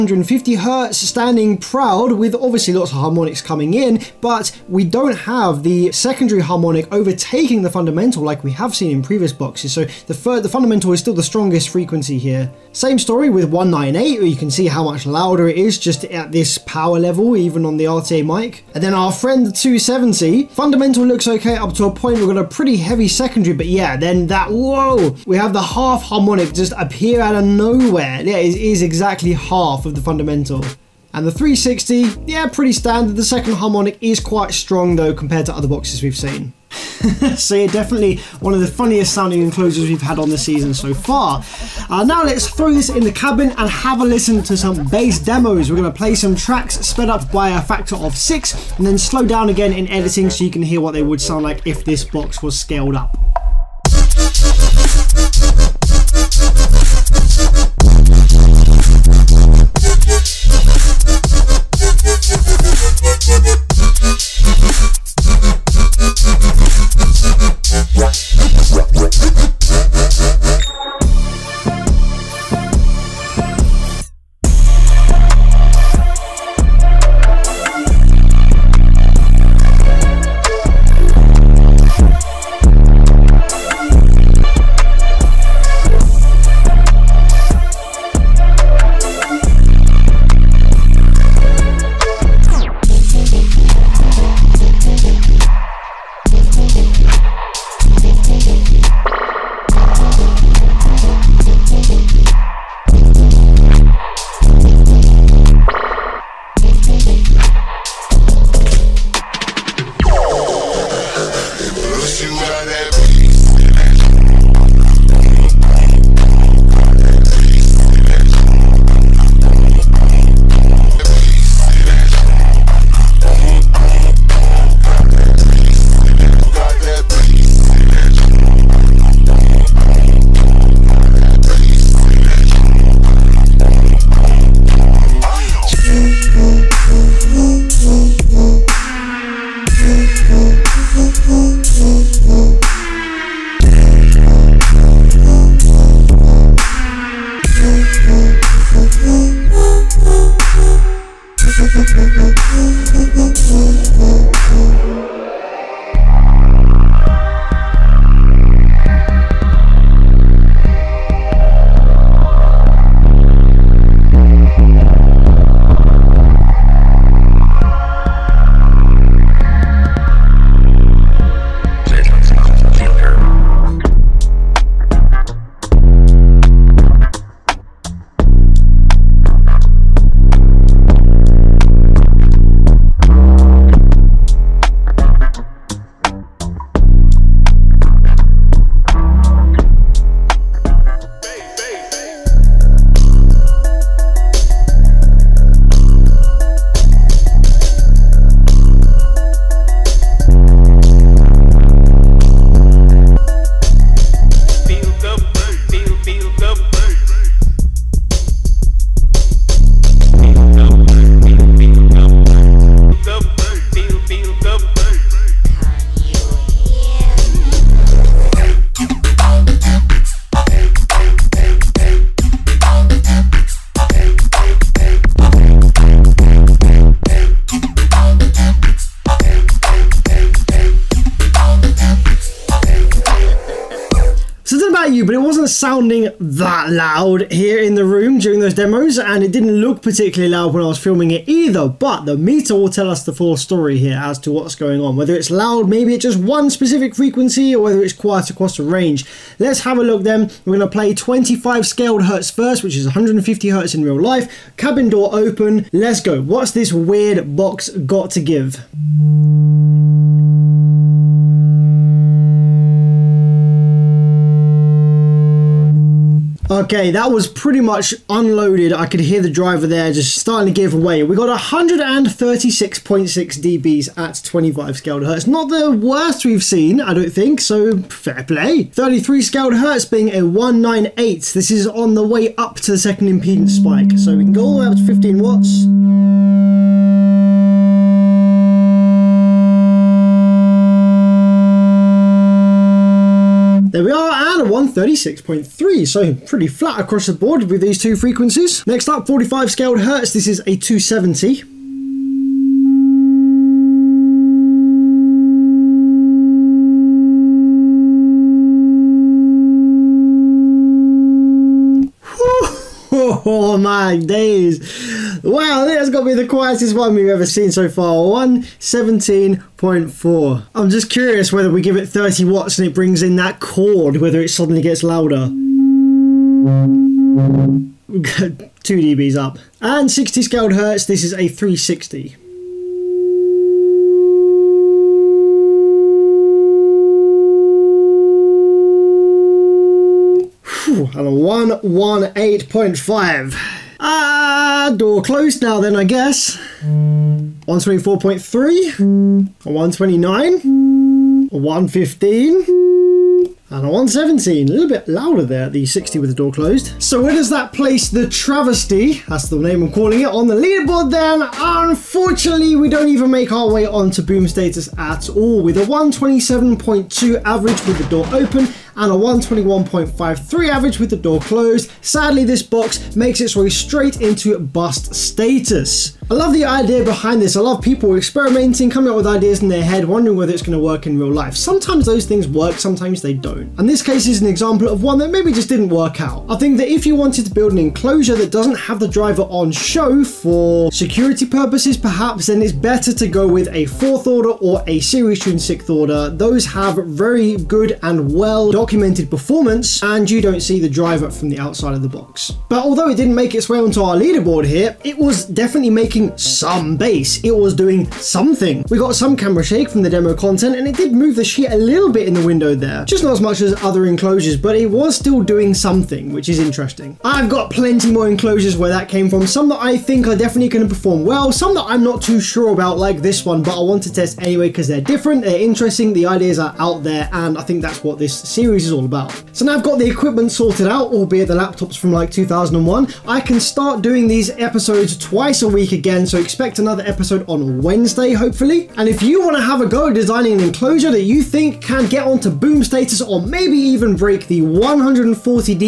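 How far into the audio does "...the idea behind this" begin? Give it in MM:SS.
06:16.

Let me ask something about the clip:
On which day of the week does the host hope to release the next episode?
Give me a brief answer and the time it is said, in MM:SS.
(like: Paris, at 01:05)
Wednesday, at 07:17.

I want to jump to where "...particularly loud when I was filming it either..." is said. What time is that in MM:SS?
03:59.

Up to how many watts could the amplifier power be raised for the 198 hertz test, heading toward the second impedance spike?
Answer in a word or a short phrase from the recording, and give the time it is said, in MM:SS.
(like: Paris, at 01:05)
15 watts, at 04:44.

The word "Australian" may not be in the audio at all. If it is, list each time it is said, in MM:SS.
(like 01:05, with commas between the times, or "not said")
not said.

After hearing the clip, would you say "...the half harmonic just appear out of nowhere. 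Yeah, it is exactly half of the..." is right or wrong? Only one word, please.
right.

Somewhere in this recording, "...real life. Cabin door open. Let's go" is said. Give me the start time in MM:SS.
04:13.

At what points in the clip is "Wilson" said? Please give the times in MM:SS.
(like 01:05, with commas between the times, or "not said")
not said.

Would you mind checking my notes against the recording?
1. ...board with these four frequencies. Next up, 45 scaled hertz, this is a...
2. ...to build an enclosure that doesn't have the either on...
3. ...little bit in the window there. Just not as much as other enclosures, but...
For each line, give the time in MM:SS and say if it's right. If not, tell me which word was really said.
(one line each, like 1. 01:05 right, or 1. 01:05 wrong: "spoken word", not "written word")
1. 04:57 wrong: "two", not "four"
2. 06:27 wrong: "driver", not "either"
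3. 06:51 right.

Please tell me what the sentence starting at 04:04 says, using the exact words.
Whether it's loud, maybe it's just one specific frequency, or whether it's quiet across the range.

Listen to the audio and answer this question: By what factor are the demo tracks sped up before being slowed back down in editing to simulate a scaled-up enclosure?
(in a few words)
6.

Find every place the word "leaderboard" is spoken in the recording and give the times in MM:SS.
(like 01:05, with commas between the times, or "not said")
06:00, 06:43.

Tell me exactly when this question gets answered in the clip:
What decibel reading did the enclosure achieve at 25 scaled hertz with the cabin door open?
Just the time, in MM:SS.
04:31.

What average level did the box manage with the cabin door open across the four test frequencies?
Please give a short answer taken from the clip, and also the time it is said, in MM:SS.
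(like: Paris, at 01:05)
127.2, at 06:05.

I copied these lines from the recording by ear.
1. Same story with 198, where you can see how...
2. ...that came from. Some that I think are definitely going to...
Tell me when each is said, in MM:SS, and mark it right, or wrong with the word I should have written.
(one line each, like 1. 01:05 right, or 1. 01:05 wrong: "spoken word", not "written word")
1. 00:12 right
2. 06:58 right.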